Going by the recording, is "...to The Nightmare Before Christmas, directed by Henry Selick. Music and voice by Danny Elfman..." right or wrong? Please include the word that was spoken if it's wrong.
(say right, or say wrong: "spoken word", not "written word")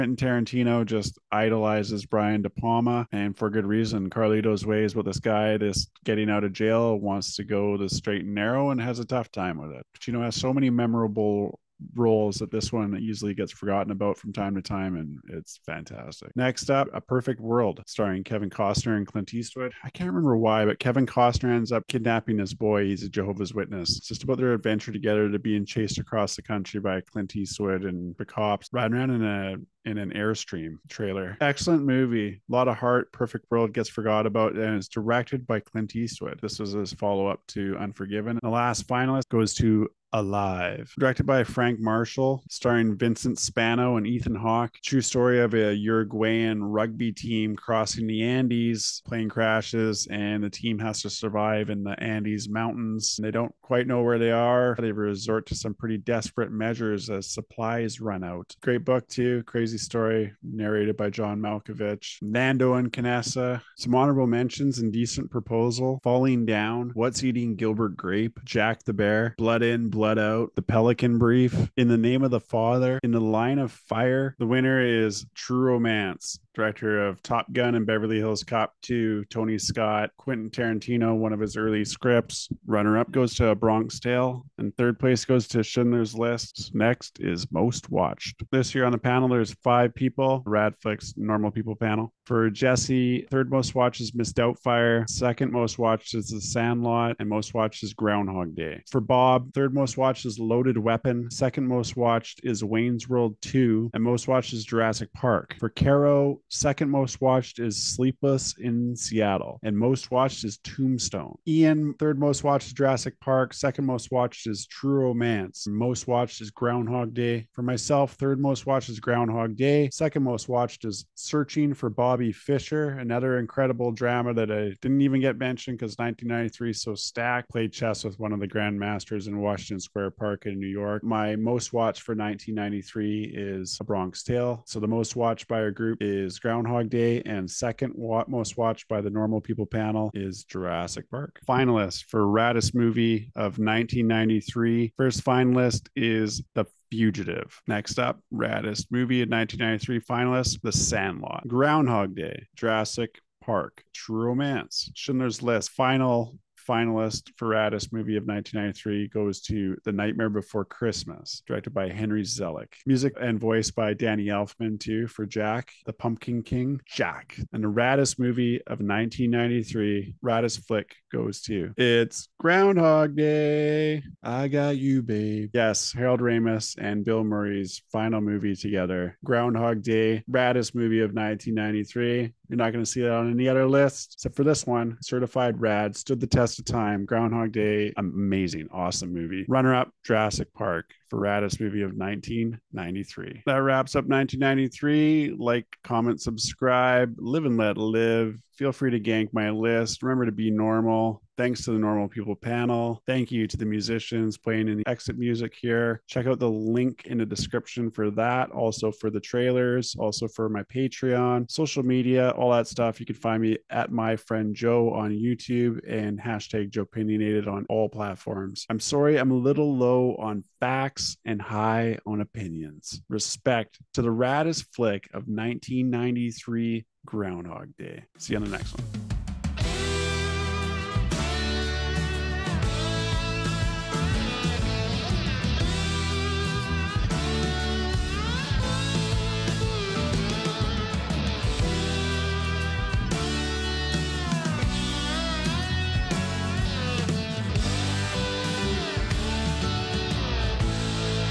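right.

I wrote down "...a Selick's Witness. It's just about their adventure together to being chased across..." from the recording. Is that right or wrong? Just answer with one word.
wrong.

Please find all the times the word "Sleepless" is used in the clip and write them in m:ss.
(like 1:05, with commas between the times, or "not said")
1:47.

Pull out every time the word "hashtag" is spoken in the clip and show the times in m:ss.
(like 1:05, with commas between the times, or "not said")
3:36.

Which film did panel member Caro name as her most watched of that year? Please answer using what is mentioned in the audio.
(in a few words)
Tombstone.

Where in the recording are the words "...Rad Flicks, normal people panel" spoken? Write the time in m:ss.
1:30.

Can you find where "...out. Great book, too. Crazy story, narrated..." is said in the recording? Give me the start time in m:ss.
0:58.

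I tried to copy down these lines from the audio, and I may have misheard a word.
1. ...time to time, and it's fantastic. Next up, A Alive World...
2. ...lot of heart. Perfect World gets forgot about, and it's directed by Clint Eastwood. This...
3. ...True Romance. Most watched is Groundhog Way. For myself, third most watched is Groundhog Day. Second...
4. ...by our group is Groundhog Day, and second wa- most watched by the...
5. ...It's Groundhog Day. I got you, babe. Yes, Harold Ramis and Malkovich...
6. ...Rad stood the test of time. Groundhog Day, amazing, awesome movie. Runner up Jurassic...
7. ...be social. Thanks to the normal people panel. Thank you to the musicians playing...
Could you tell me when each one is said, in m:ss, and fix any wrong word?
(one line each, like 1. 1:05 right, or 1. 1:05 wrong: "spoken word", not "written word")
1. 0:14 wrong: "Perfect", not "Alive"
2. 0:32 right
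3. 1:54 wrong: "Day", not "Way"
4. 2:15 right
5. 2:51 wrong: "Bill", not "Malkovich"
6. 3:05 right
7. 3:20 wrong: "normal", not "social".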